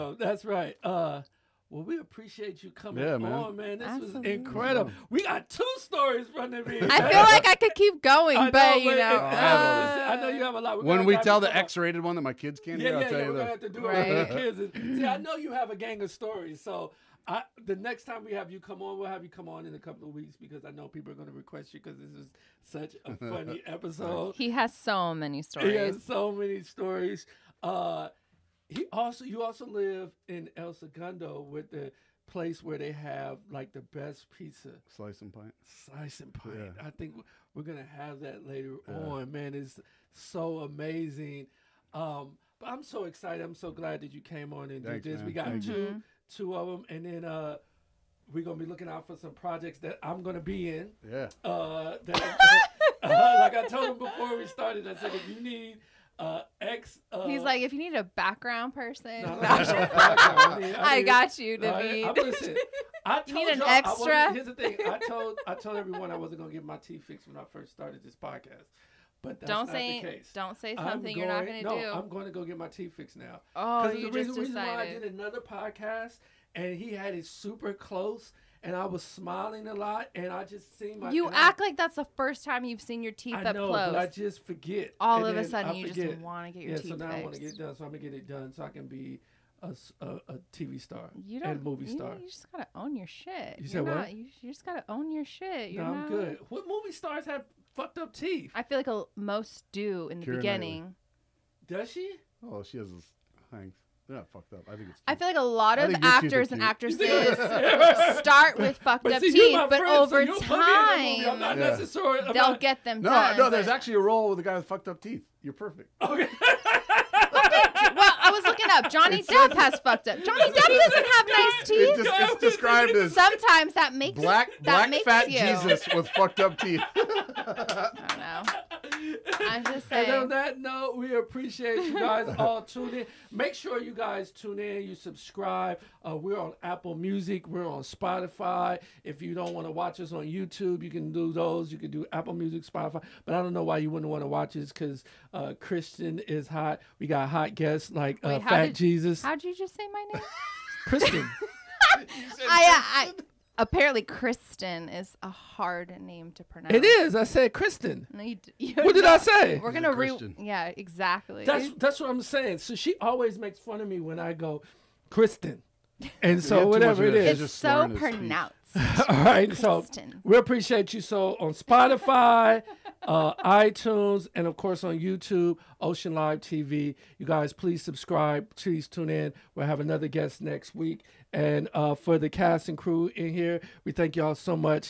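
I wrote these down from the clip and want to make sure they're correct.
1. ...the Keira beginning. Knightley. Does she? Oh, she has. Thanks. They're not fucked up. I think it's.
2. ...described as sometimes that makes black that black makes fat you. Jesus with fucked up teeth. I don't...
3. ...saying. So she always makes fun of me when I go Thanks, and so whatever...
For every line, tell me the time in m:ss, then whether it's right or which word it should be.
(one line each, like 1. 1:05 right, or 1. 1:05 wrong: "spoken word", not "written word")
1. 1:40 right
2. 2:02 right
3. 2:42 wrong: "Kristen", not "Thanks".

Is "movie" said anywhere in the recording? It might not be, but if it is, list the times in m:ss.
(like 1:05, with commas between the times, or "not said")
1:31, 1:36.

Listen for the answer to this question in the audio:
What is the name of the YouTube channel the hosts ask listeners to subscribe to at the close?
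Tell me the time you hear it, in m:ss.
2:55.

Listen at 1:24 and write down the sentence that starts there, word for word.
All and of a sudden, I you forget.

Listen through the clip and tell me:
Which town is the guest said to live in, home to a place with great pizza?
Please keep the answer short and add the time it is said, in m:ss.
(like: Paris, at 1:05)
El Segundo, at 0:30.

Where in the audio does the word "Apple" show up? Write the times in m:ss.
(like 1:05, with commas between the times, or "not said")
2:16, 2:22.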